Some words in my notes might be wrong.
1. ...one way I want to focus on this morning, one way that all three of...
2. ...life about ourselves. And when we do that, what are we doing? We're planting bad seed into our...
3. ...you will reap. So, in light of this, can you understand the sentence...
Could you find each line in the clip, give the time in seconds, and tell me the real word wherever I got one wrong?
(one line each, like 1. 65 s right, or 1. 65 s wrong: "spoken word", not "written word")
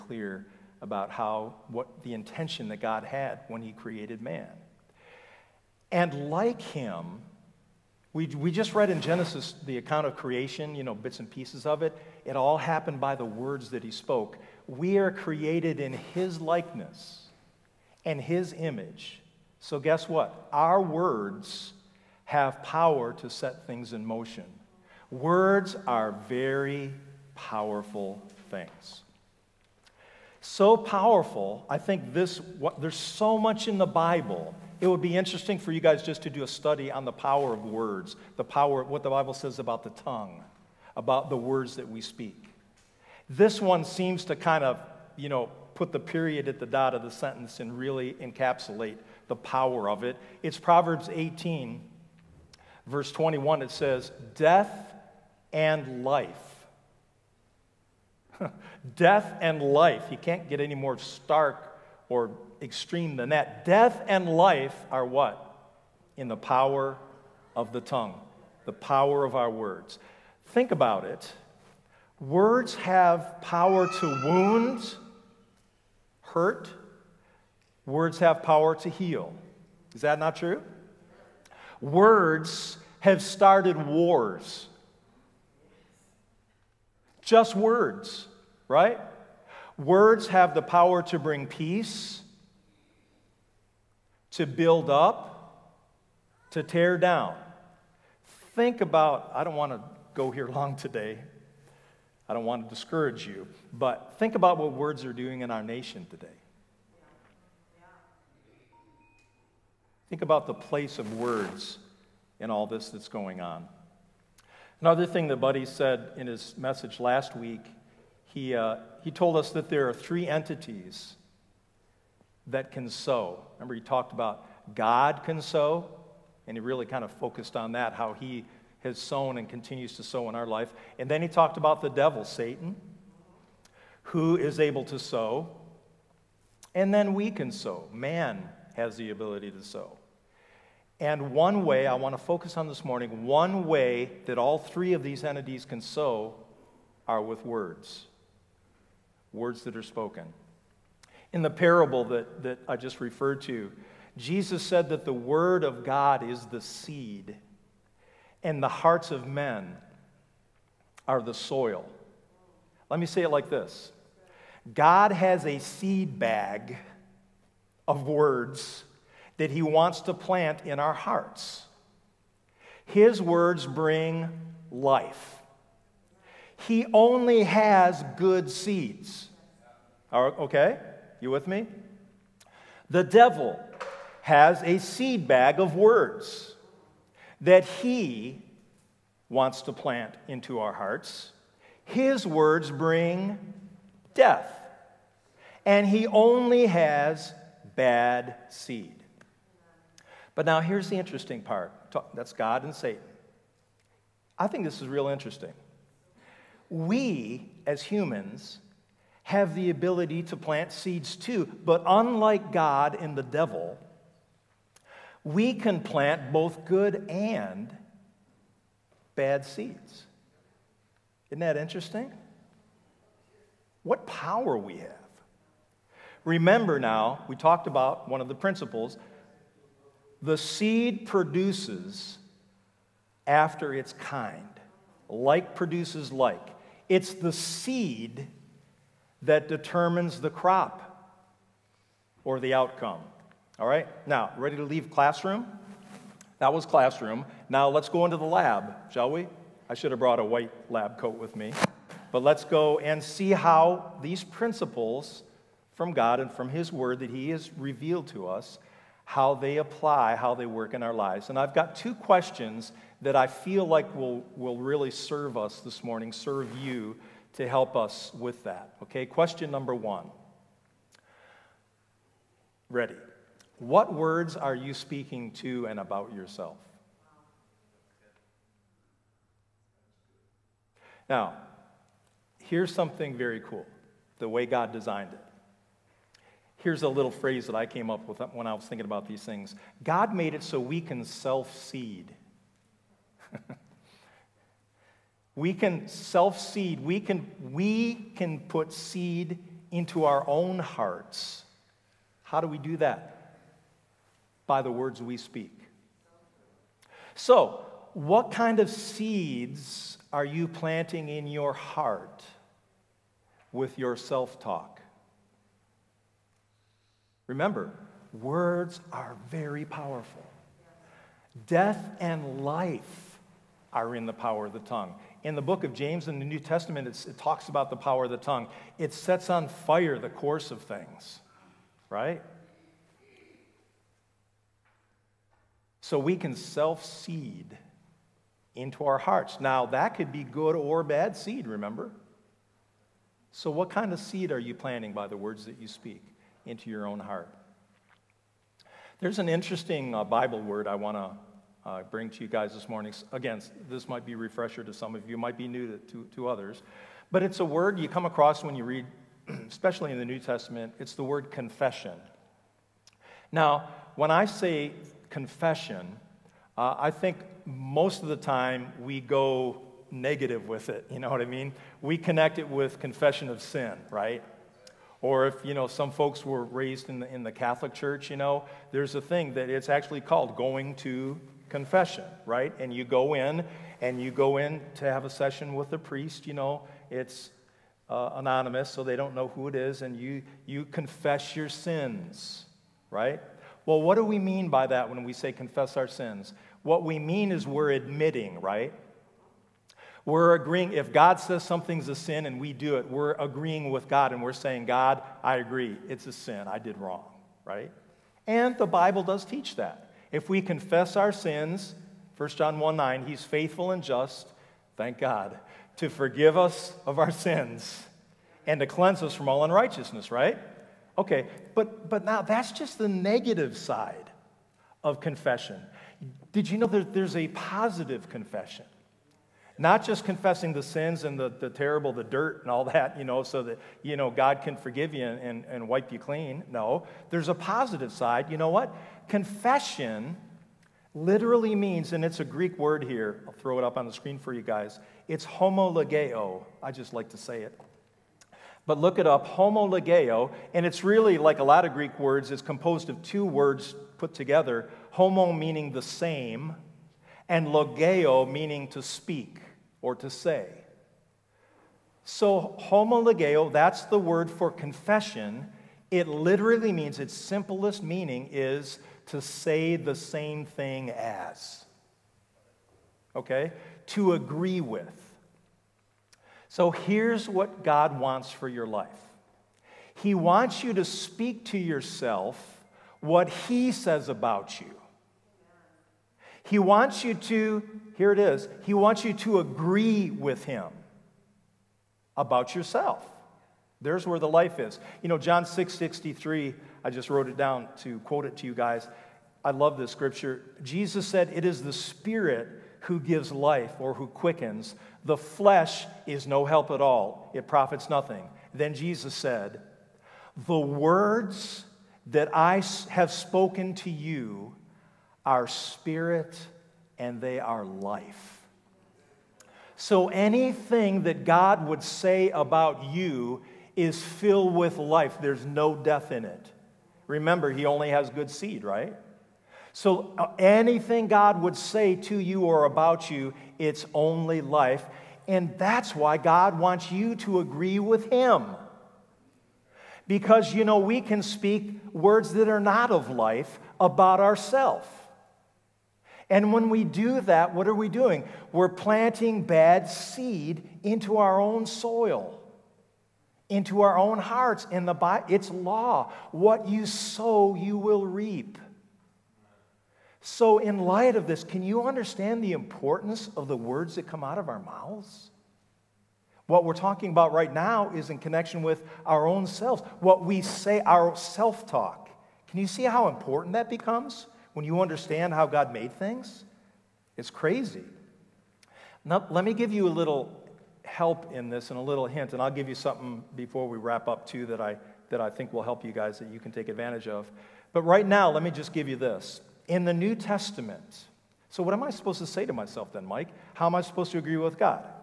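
1. 141 s right
2. 543 s right
3. 557 s wrong: "importance", not "sentence".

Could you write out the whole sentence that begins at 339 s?
Now, that could be good or bad seed, remember?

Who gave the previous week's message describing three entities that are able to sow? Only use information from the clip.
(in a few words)
Buddy.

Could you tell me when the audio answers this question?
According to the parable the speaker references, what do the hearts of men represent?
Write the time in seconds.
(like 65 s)
161 s.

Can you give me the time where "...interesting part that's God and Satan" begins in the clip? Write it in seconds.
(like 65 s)
200 s.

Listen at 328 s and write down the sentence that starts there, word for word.
It sets on fire the course of things, right?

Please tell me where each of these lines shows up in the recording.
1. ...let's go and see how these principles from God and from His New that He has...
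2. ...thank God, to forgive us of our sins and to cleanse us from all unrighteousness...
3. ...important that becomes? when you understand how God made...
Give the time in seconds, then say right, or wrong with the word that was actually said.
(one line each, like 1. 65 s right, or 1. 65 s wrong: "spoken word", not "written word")
1. 252 s wrong: "Word", not "New"
2. 414 s right
3. 573 s right.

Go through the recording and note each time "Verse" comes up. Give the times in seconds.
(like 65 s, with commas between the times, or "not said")
52 s.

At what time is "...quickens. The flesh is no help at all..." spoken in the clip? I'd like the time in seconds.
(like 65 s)
504 s.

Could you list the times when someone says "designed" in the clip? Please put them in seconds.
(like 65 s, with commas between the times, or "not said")
284 s.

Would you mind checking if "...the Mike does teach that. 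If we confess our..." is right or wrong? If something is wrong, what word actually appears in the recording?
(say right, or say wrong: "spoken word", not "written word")
wrong: "Bible", not "Mike".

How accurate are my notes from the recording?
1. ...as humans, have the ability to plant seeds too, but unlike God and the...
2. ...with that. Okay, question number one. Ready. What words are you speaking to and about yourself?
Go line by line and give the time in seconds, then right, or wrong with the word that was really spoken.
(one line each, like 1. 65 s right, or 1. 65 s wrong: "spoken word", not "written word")
1. 207 s right
2. 268 s right.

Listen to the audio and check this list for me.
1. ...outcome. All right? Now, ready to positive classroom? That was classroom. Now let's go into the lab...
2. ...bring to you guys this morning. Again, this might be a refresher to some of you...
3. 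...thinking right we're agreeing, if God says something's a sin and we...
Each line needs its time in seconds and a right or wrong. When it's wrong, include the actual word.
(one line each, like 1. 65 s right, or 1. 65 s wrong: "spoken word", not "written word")
1. 242 s wrong: "leave", not "positive"
2. 351 s right
3. 397 s wrong: "admitting", not "thinking".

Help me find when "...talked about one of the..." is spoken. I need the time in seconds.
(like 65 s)
227 s.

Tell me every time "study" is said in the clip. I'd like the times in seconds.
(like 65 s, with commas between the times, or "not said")
36 s.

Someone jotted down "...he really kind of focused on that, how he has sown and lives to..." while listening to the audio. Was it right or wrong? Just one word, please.
wrong.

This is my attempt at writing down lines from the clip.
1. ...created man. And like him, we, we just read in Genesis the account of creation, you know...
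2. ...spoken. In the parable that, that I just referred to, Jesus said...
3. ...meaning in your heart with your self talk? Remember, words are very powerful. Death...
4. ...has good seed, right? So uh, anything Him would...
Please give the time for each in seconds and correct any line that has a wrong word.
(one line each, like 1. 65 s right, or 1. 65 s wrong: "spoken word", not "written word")
1. 3 s right
2. 149 s right
3. 310 s wrong: "planting", not "meaning"
4. 527 s wrong: "God", not "Him".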